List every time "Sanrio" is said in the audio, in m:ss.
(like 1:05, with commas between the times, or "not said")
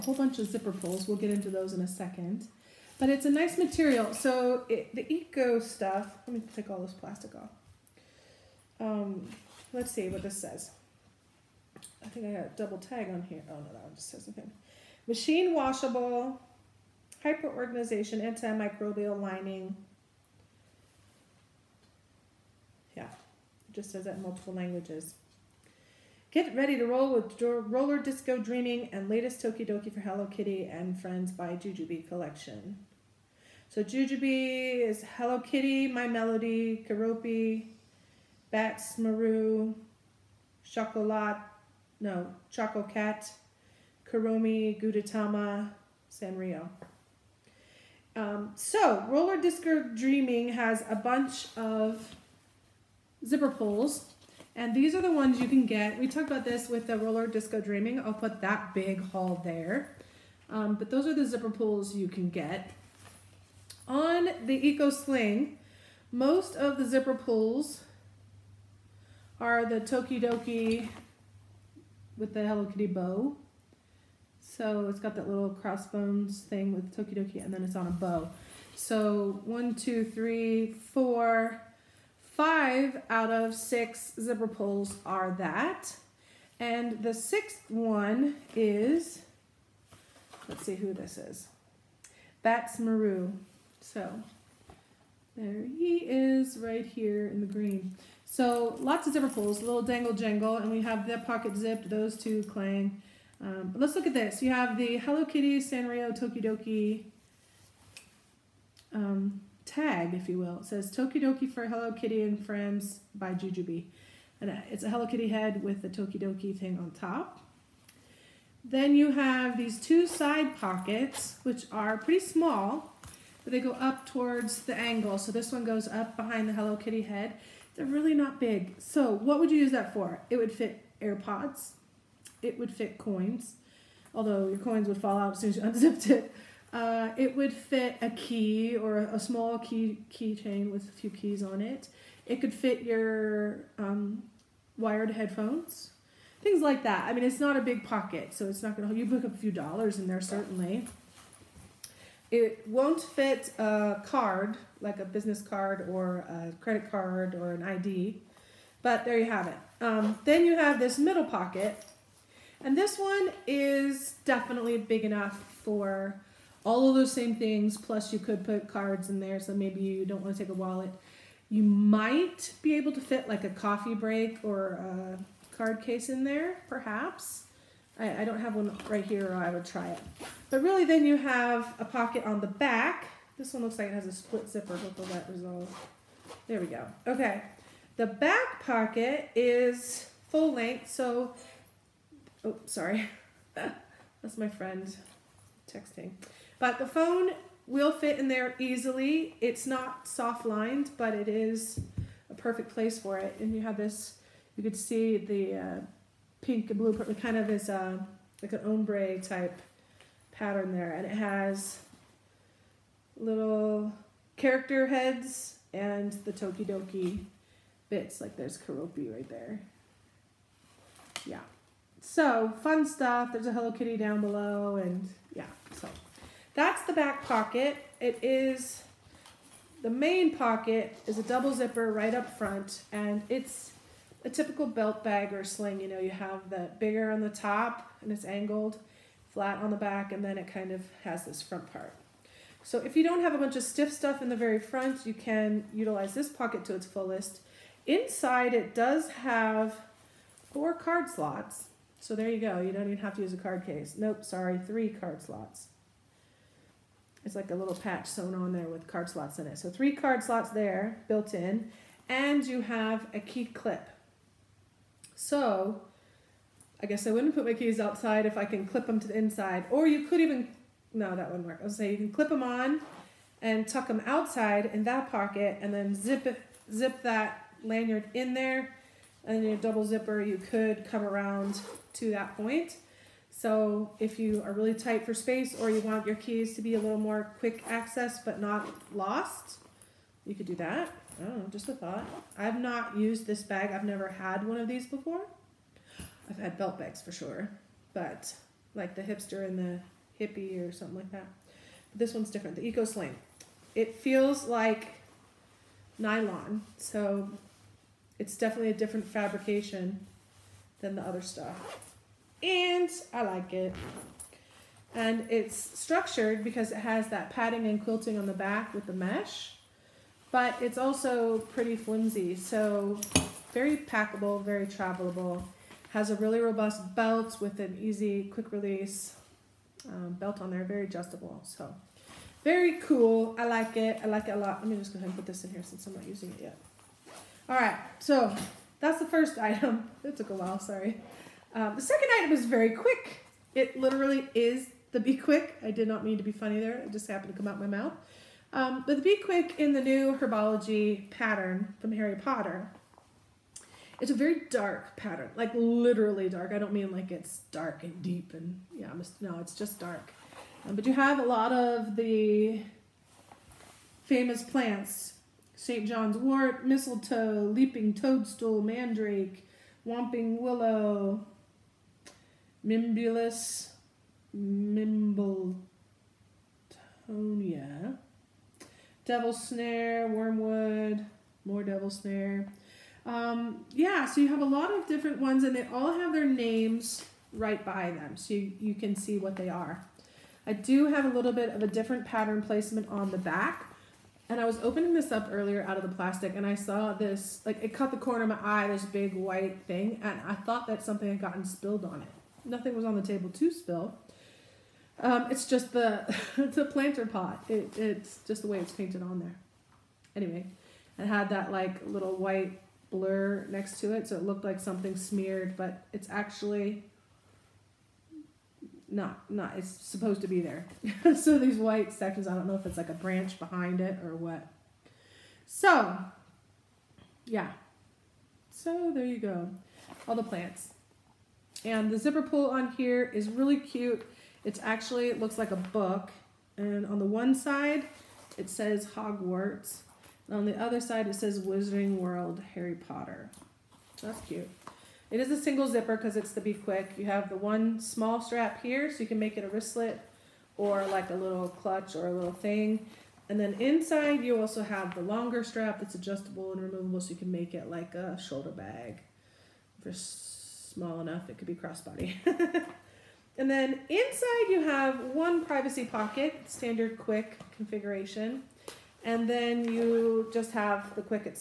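0:46, 1:45.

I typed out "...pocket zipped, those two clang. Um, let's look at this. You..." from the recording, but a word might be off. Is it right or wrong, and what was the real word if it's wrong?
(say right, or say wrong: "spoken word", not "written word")
right.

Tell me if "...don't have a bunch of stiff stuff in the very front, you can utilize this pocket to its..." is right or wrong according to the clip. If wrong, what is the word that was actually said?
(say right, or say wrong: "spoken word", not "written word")
right.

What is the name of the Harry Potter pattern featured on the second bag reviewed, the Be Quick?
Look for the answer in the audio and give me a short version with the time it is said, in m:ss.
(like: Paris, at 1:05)
Herbology, at 5:50.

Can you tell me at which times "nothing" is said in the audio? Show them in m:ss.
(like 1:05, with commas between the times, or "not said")
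0:14, 6:42.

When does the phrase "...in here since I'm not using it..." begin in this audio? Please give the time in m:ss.
5:35.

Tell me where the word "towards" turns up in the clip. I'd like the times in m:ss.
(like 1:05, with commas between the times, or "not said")
2:04.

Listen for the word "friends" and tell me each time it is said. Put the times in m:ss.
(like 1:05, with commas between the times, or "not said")
0:30, 1:52, 3:14.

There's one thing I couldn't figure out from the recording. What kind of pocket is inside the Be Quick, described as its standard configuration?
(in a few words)
privacy pocket.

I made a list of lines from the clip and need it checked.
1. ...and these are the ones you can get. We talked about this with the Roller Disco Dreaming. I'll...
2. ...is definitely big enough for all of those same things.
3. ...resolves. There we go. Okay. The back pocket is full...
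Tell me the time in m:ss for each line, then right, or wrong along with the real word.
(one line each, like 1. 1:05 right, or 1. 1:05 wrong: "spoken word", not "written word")
1. 0:54 right
2. 2:43 right
3. 3:05 right.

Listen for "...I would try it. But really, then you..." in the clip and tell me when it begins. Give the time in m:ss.
2:59.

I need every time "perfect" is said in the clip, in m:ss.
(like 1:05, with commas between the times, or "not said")
3:22.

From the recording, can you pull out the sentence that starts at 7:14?
It's actually, it looks like a book.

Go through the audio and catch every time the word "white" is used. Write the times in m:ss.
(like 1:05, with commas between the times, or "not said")
6:39, 6:52, 7:01.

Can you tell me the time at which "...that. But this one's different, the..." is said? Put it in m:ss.
5:01.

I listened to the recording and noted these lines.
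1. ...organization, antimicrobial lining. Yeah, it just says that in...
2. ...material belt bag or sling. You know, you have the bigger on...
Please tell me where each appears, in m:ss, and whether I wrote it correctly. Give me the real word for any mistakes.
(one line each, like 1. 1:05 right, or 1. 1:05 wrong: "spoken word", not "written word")
1. 0:17 right
2. 3:54 wrong: "typical", not "material".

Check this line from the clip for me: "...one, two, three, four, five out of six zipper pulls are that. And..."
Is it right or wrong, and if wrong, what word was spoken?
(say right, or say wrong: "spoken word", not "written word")
right.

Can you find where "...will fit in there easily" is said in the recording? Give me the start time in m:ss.
3:17.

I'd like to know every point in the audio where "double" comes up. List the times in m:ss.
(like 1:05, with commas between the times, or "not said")
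0:12, 3:51, 4:39.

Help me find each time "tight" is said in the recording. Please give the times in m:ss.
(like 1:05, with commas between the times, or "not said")
4:44.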